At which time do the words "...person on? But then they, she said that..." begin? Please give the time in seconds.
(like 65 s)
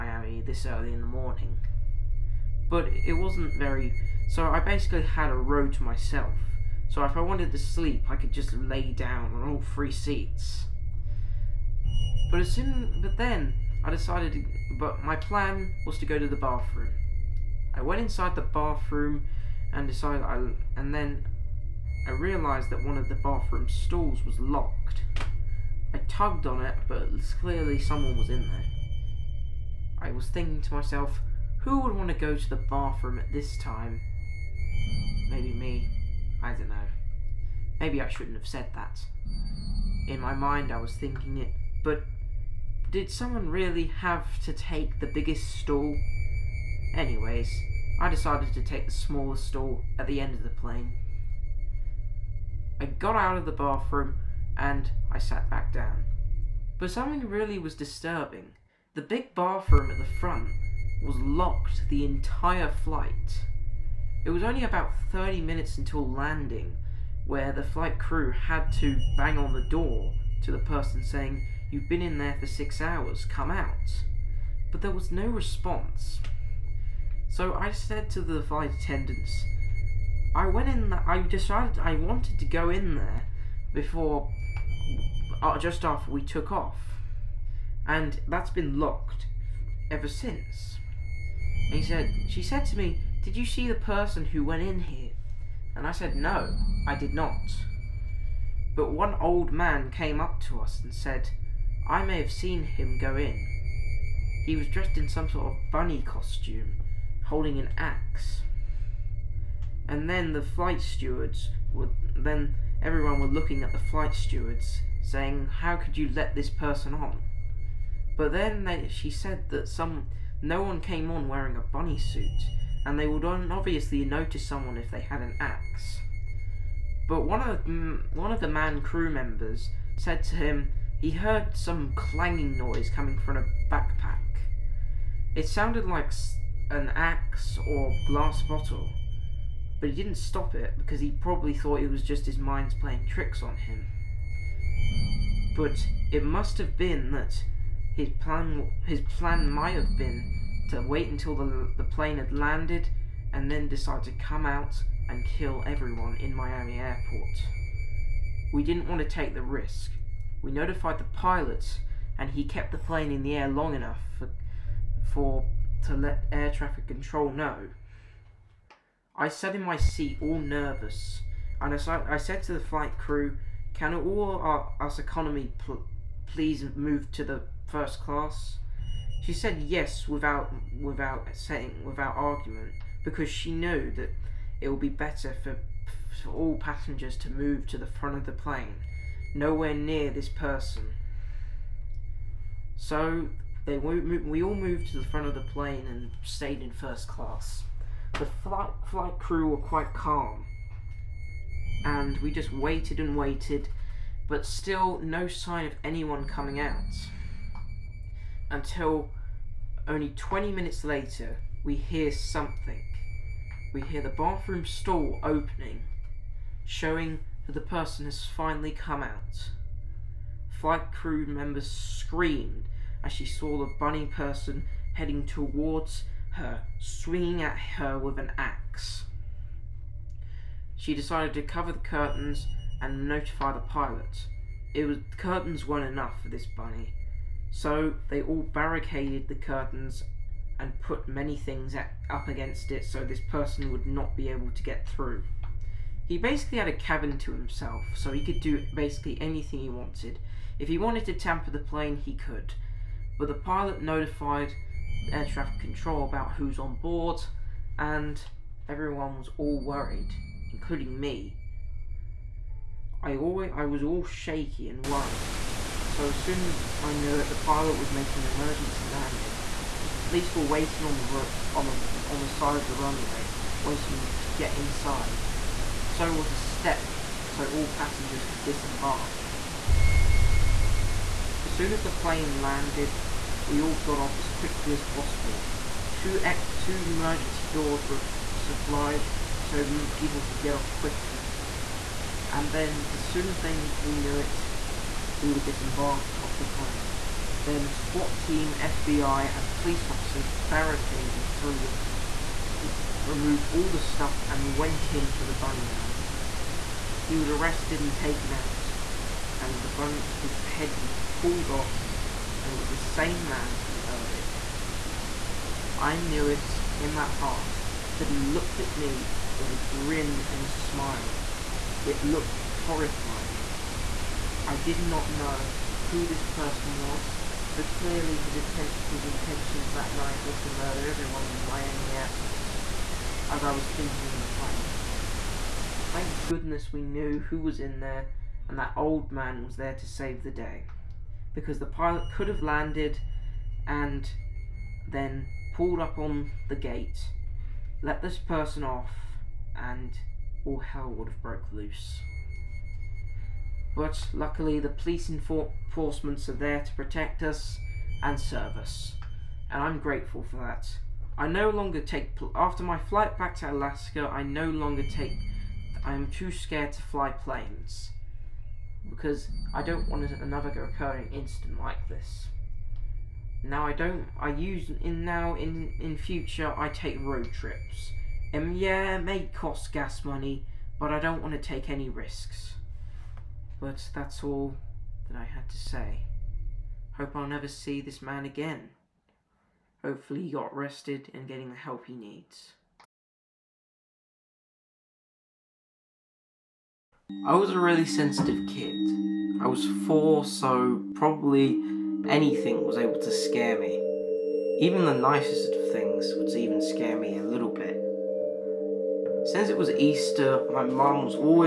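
116 s.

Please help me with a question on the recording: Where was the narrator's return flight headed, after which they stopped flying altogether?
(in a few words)
Alaska.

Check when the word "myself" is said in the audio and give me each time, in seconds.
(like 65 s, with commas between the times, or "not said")
5 s, 30 s.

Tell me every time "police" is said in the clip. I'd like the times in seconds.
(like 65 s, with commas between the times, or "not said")
270 s, 299 s, 354 s.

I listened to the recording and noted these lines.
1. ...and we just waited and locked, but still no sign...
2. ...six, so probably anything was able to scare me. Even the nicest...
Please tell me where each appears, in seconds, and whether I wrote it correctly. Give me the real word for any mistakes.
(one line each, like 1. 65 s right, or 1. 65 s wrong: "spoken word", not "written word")
1. 201 s wrong: "waited", not "locked"
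2. 399 s wrong: "four", not "six".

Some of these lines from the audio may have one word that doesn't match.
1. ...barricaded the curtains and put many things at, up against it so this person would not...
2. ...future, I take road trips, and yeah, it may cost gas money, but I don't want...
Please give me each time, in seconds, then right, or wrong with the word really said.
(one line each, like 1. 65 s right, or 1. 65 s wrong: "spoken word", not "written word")
1. 238 s right
2. 375 s right.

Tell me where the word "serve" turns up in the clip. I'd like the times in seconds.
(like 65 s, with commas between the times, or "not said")
358 s.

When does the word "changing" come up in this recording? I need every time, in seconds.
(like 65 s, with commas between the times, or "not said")
not said.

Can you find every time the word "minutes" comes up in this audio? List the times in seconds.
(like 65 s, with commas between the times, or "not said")
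65 s, 210 s.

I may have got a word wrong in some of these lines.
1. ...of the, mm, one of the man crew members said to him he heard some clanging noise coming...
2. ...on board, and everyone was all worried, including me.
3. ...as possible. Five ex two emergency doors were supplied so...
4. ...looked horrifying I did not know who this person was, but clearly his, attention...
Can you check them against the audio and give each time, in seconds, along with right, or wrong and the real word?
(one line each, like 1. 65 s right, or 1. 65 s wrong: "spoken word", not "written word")
1. 127 s right
2. 256 s right
3. 284 s wrong: "Two", not "Five"
4. 322 s right.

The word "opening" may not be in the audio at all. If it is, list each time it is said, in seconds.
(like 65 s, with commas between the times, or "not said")
215 s.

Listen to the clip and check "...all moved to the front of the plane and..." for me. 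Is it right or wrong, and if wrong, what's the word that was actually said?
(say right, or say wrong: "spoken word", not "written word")
right.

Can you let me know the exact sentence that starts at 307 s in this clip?
He was arrested and taken out, and the bun- his head was pulled off, and it was the same man from earlier.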